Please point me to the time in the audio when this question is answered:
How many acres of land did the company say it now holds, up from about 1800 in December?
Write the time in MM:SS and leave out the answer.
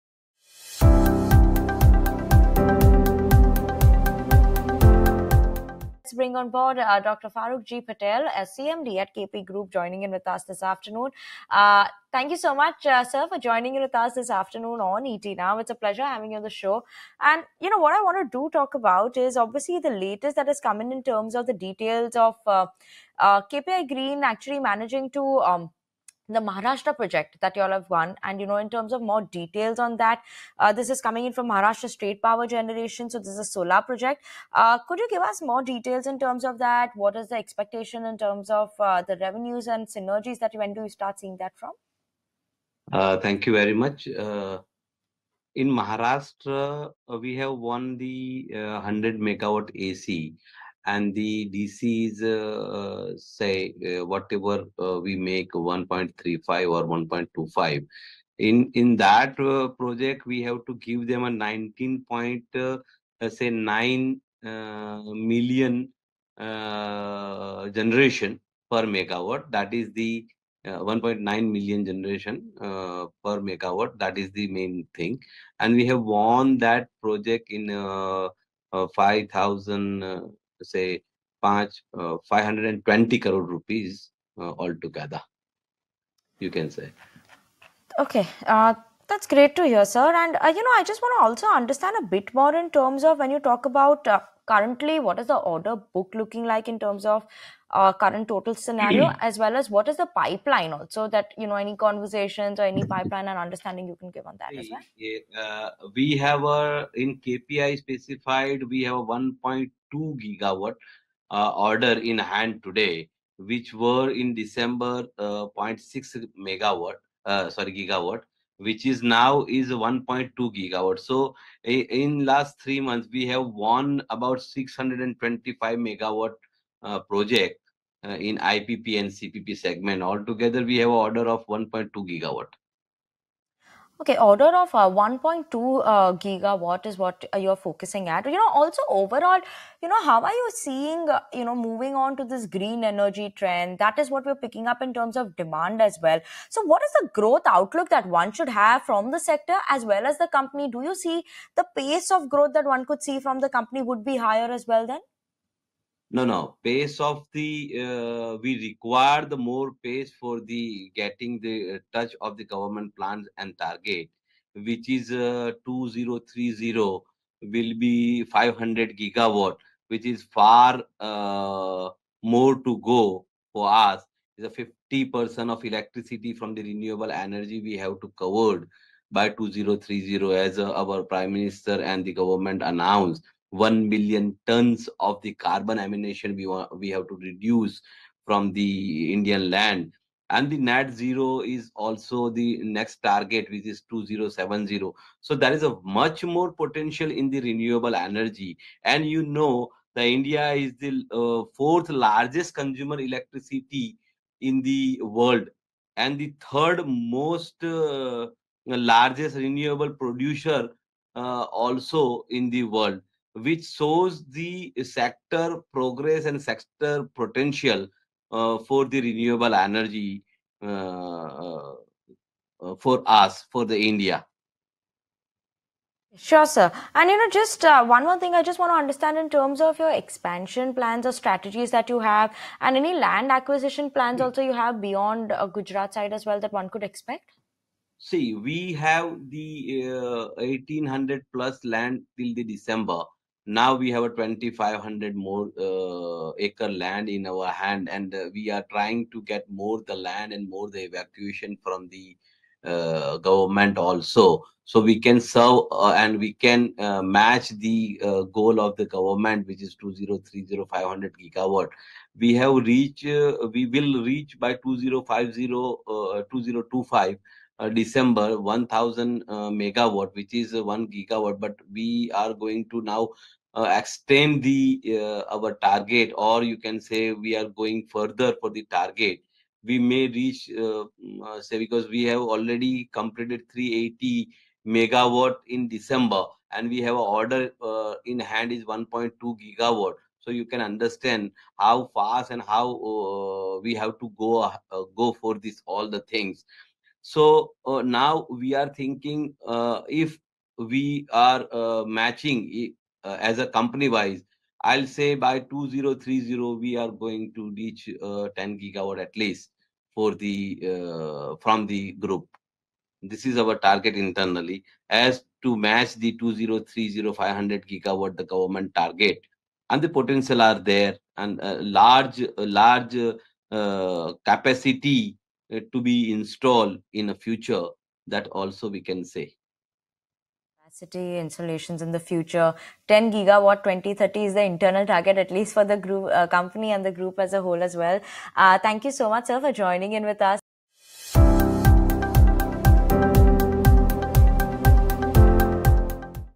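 04:04.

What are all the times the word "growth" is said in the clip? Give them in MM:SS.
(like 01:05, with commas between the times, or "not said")
02:27, 02:32.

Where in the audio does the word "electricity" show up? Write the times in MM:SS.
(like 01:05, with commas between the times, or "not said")
02:55, 03:23.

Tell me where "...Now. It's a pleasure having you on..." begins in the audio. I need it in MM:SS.
00:15.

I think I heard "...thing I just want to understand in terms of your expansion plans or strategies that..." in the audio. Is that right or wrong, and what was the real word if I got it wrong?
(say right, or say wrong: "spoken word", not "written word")
right.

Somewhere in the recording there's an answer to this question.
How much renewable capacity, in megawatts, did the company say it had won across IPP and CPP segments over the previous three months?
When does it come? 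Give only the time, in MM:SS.
02:04.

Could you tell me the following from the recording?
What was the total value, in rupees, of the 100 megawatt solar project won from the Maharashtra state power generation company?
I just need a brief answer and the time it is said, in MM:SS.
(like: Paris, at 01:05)
520 crore rupees, at 01:22.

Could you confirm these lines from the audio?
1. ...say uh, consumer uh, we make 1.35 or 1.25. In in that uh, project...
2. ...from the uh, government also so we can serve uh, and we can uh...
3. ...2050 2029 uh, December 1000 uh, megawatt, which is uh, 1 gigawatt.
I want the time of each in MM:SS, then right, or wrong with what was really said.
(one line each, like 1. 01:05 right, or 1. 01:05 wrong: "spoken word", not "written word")
1. 00:53 wrong: "whatever", not "consumer"
2. 04:11 right
3. 04:24 wrong: "2025", not "2029".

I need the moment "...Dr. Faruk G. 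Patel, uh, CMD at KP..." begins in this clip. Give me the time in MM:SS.
00:07.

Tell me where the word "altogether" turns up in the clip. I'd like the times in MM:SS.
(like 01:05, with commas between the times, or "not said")
01:24, 02:10.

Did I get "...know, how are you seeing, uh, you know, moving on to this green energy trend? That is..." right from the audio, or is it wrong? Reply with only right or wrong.
right.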